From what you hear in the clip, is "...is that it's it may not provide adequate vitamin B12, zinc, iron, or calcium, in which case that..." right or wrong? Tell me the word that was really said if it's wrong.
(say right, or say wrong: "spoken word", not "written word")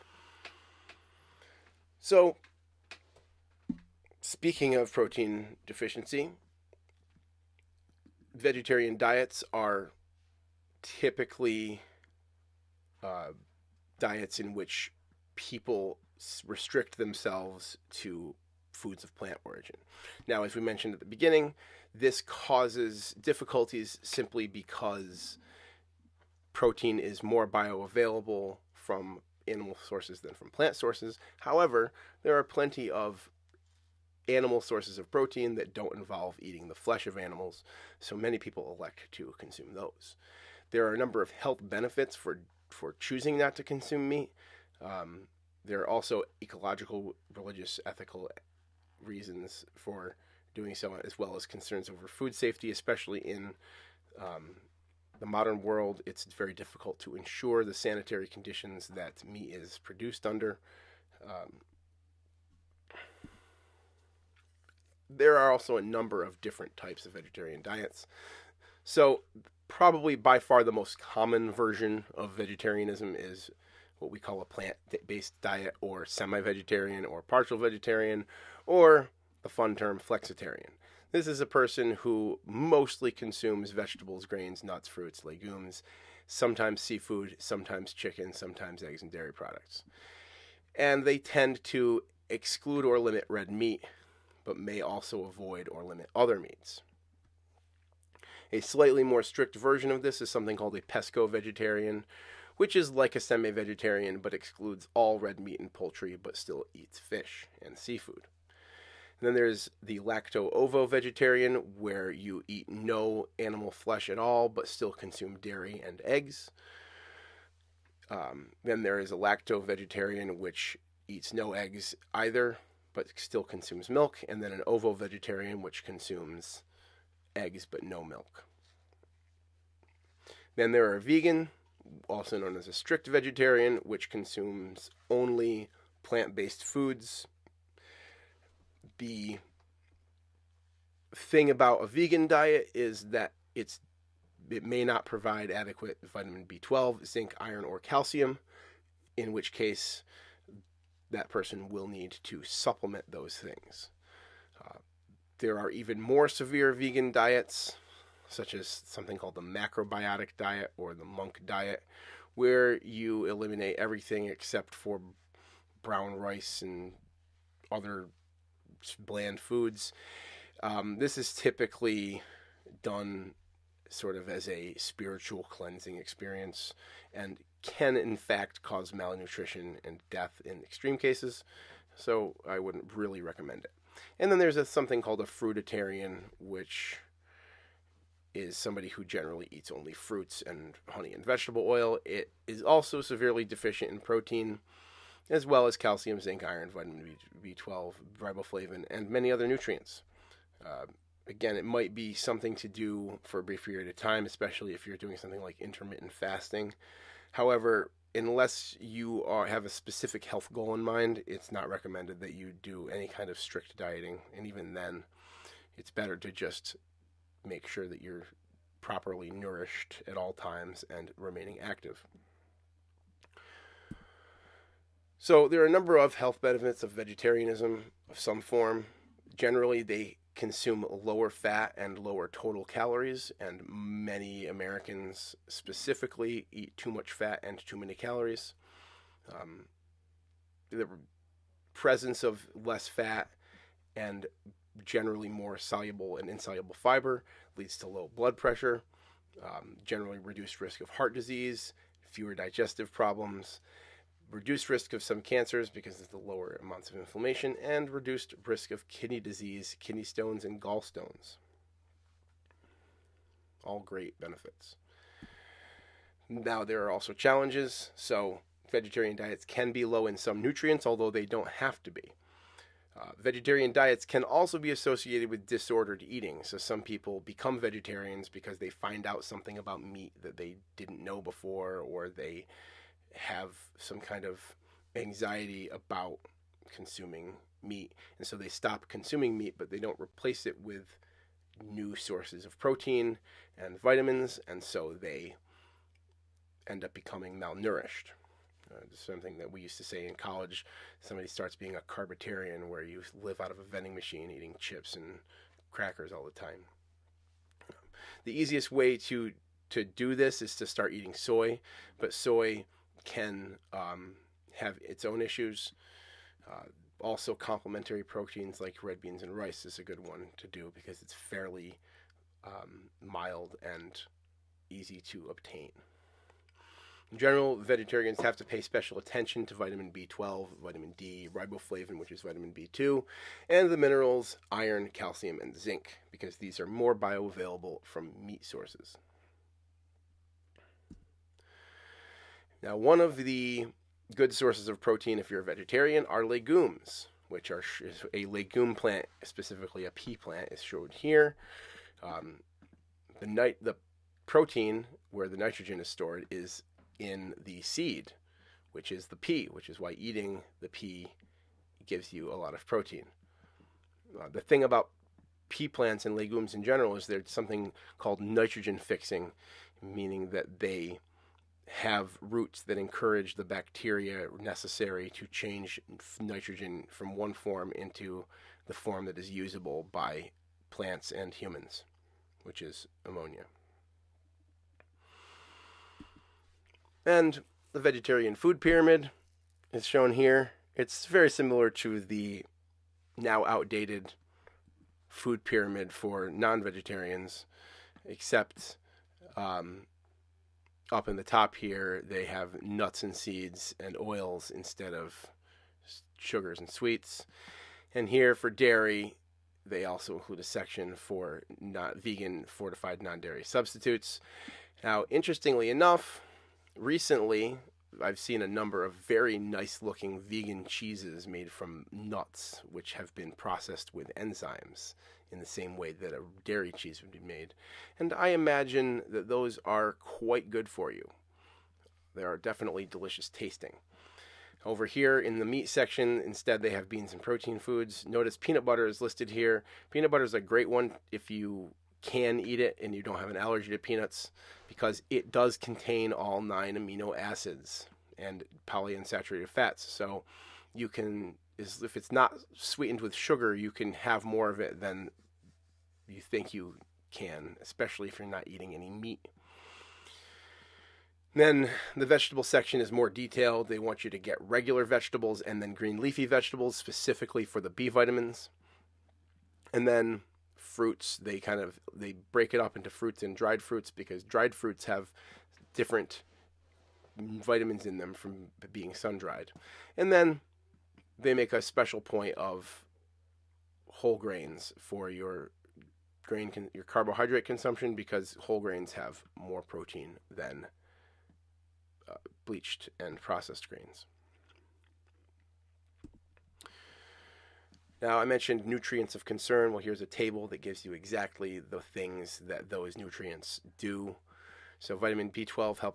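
right.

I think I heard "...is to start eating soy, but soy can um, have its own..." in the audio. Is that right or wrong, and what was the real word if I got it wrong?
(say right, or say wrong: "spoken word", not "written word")
right.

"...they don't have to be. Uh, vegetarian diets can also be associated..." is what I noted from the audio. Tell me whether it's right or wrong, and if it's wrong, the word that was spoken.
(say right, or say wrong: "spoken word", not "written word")
right.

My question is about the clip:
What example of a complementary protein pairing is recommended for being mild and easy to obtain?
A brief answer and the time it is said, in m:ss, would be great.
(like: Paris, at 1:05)
red beans and rice, at 5:18.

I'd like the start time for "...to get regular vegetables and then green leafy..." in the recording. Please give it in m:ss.
7:44.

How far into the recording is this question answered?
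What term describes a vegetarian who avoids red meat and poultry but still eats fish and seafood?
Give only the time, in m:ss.
1:40.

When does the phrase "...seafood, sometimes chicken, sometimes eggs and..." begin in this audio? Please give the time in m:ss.
1:26.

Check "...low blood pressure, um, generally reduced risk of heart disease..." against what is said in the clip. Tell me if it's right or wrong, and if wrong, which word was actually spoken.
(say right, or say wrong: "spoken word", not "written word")
right.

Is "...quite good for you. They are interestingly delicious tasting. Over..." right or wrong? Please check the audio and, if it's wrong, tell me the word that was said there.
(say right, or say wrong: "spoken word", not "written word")
wrong: "definitely", not "interestingly".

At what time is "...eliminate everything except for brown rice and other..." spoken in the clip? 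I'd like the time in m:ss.
2:43.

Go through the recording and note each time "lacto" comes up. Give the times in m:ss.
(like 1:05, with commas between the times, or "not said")
1:49, 1:59.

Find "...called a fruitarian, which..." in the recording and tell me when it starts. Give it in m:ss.
3:05.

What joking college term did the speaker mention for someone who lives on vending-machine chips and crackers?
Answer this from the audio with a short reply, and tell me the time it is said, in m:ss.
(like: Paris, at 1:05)
carbitarian, at 5:01.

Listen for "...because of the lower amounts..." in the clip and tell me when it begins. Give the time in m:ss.
4:15.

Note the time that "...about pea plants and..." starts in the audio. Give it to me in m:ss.
6:04.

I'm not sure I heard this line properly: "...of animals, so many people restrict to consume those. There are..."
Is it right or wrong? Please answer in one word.
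wrong.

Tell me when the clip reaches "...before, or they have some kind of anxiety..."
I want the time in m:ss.
4:41.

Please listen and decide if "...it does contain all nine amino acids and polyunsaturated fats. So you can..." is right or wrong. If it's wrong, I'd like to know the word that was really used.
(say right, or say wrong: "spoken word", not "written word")
right.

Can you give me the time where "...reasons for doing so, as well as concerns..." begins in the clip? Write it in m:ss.
0:49.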